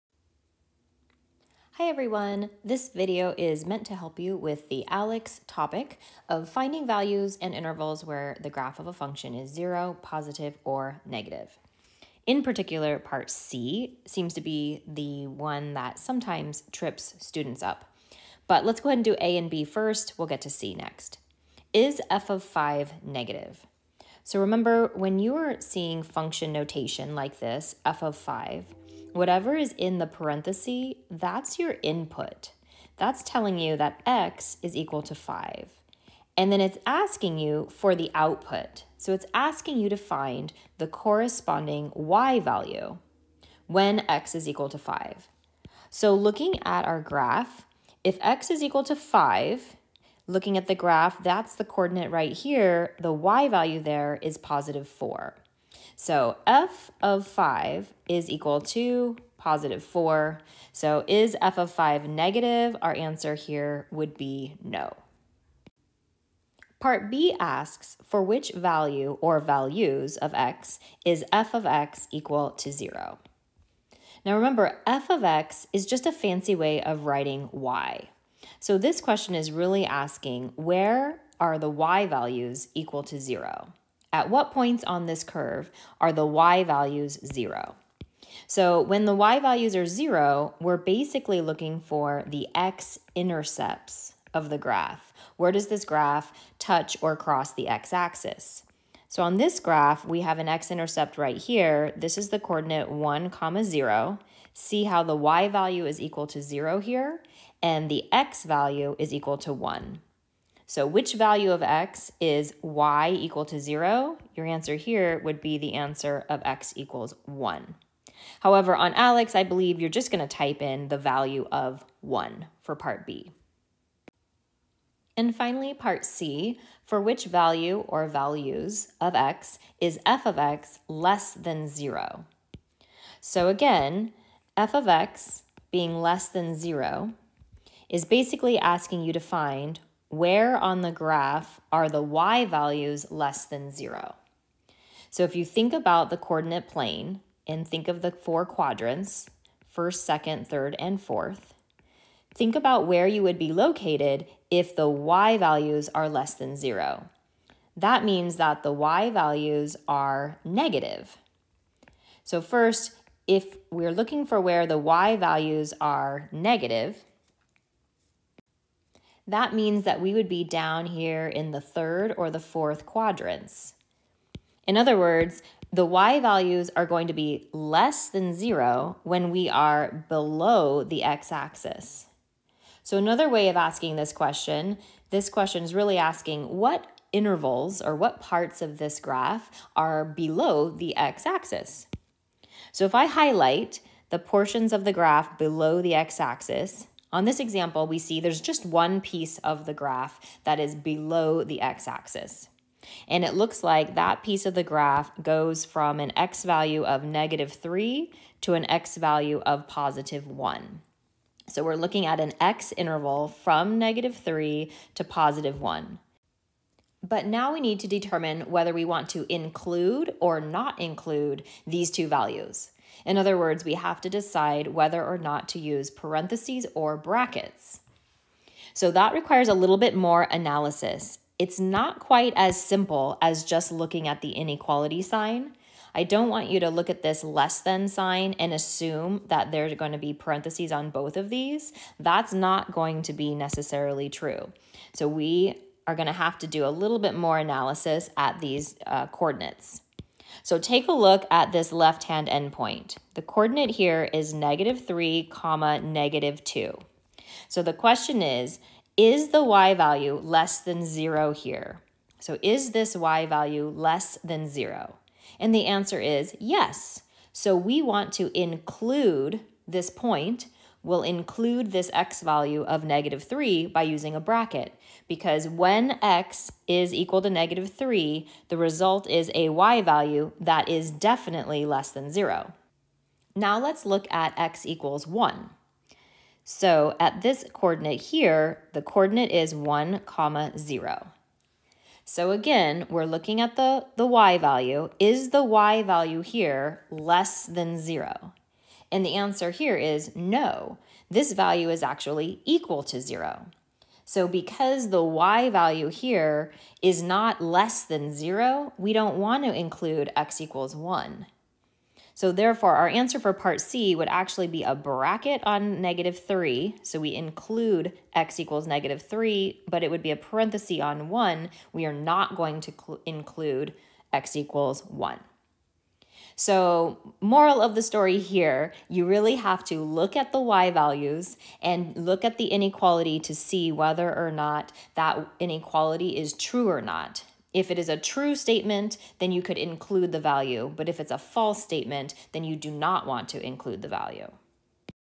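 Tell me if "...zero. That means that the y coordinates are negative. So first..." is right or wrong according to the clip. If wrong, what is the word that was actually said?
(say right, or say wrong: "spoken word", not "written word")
wrong: "values", not "coordinates".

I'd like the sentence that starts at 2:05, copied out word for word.
And finally, part C, for which value or values of x is f of x less than 0?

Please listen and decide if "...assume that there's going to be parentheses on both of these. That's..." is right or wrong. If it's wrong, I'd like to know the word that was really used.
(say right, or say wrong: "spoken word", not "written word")
right.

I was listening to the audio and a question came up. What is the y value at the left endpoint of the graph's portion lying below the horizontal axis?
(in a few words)
-2.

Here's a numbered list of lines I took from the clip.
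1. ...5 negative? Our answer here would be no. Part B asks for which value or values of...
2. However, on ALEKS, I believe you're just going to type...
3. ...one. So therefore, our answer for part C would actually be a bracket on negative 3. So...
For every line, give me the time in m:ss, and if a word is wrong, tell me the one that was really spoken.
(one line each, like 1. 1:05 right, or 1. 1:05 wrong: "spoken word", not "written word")
1. 1:01 right
2. 1:58 right
3. 5:10 right.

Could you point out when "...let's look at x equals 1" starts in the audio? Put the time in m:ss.
4:43.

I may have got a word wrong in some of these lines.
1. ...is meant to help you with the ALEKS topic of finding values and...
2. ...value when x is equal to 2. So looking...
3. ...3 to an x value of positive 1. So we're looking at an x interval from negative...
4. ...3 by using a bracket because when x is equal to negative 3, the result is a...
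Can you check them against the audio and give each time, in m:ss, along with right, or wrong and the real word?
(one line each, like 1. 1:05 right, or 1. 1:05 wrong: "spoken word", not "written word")
1. 0:03 right
2. 0:42 wrong: "5", not "2"
3. 3:27 right
4. 4:33 right.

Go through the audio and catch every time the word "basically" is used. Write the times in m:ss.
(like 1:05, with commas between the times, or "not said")
1:30, 2:18.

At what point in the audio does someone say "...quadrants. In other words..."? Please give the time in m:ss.
2:52.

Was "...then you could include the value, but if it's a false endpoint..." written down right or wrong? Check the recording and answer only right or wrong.
wrong.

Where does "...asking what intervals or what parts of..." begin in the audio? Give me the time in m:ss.
3:05.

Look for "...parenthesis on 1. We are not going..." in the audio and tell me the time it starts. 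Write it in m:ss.
5:20.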